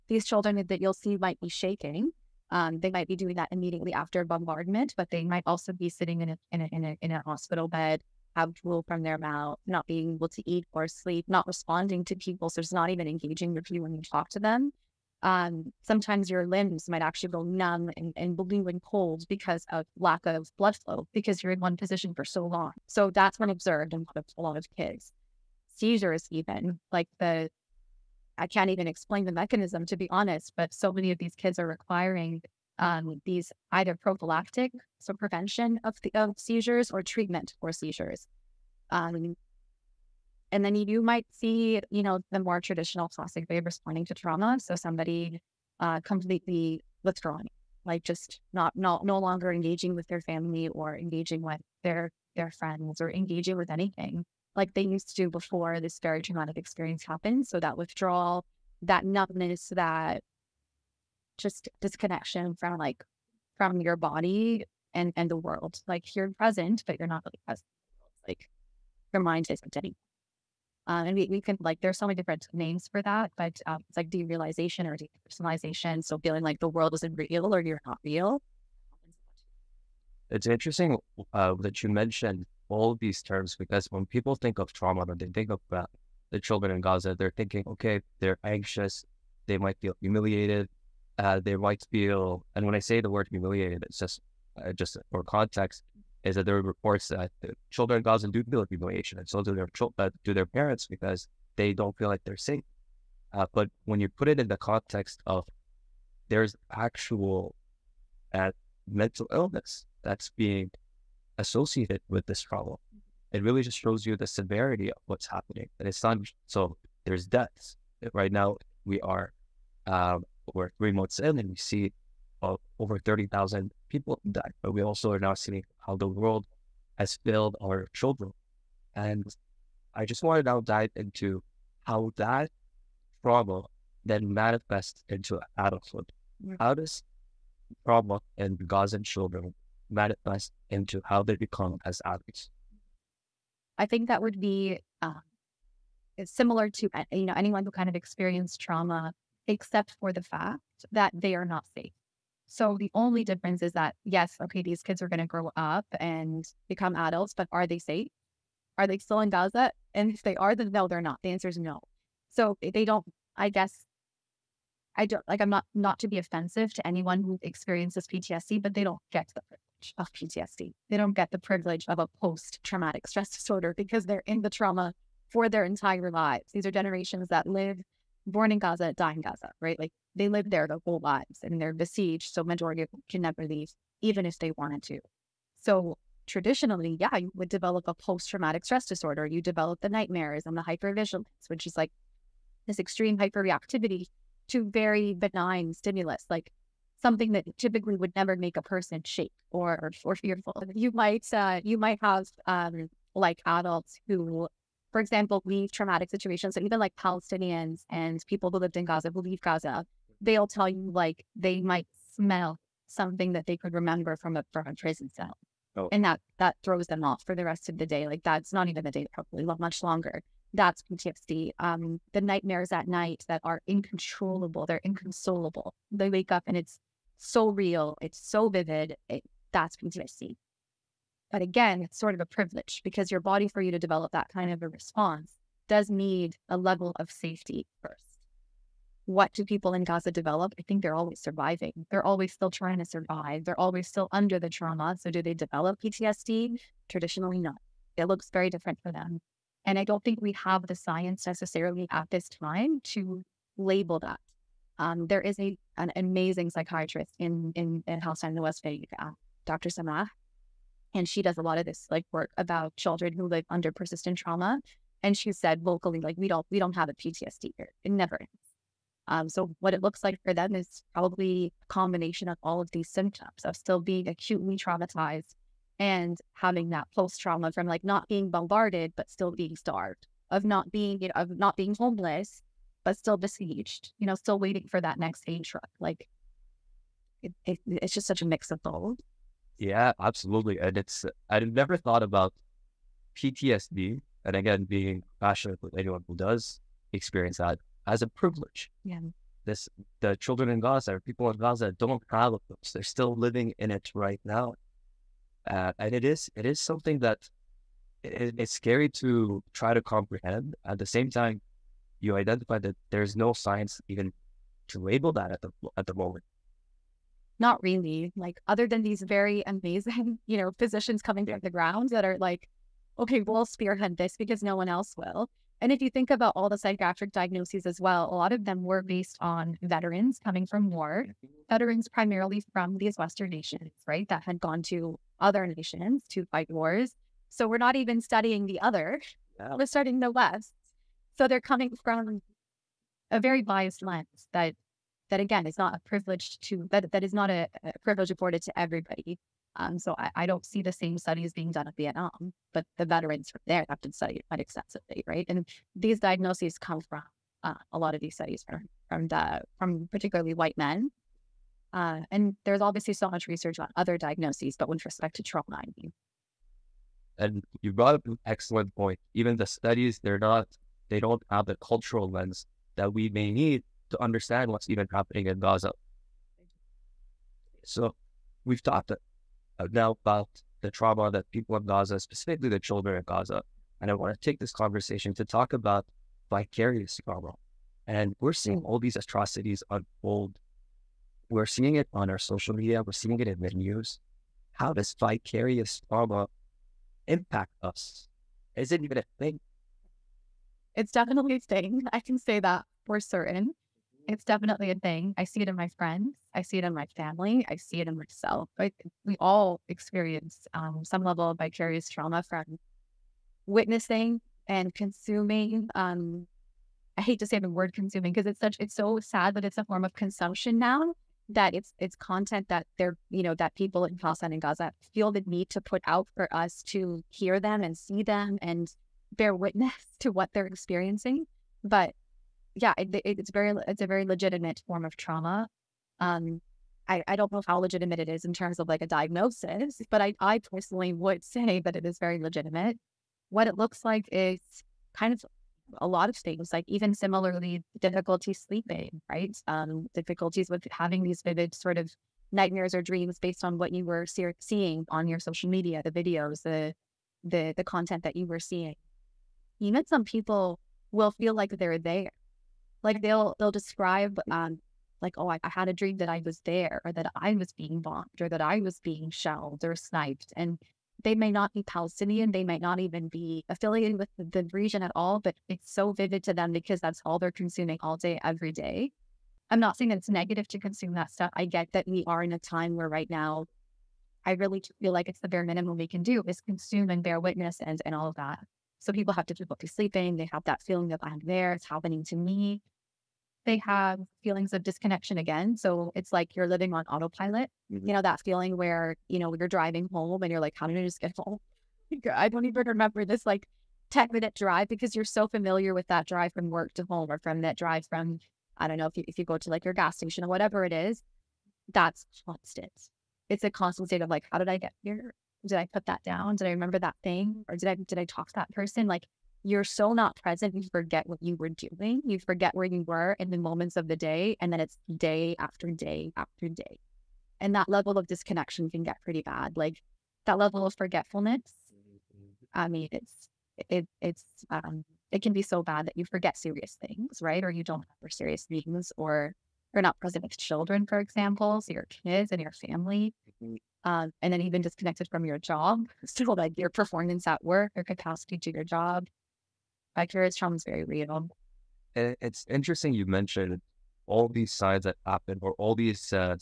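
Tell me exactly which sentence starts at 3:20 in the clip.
You might uh, you might have um, like adults who, for example, leave traumatic situations.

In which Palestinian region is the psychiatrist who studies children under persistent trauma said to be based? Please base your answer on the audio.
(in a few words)
West Bank.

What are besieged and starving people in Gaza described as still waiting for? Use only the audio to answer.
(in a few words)
aid truck.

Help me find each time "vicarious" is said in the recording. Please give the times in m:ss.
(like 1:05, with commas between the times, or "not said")
6:26, 6:34, 6:51, 9:09.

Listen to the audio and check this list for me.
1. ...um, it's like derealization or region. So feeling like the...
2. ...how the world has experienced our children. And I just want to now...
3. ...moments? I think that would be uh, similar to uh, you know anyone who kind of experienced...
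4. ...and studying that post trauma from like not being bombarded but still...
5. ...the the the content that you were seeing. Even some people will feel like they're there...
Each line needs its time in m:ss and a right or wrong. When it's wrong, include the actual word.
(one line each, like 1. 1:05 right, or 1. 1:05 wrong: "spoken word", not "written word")
1. 1:13 wrong: "depersonalization", not "region"
2. 2:05 wrong: "failed", not "experienced"
3. 2:22 wrong: "adults", not "moments"
4. 4:35 wrong: "having", not "studying"
5. 7:36 right.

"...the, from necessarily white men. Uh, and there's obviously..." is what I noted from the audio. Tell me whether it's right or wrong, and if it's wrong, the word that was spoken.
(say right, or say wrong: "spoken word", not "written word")
wrong: "particularly", not "necessarily".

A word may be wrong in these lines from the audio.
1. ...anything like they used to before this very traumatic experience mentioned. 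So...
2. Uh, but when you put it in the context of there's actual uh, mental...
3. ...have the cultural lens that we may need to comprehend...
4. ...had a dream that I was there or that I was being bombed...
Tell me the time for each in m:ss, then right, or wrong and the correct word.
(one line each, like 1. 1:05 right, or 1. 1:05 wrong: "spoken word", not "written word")
1. 0:53 wrong: "happened", not "mentioned"
2. 1:43 right
3. 6:11 wrong: "understand", not "comprehend"
4. 7:45 right.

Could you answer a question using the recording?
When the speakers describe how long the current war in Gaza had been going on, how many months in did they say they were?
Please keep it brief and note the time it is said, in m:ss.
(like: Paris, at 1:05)
3 months, at 2:00.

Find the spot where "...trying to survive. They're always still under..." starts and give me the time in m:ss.
4:02.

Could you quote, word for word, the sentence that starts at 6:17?
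So we've talked now about the trauma that people in Gaza, specifically the children in Gaza.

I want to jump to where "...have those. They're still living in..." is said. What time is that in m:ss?
5:02.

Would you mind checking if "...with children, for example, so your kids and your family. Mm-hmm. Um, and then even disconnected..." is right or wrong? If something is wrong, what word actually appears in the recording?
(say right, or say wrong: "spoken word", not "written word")
right.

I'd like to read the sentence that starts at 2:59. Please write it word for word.
Like they live there their whole lives and they're besieged.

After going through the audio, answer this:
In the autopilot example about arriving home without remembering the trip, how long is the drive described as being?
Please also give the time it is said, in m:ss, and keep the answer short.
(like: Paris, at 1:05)
10 minutes, at 8:23.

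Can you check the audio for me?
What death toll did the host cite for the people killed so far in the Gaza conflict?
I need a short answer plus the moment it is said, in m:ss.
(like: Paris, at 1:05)
over 30,000, at 2:02.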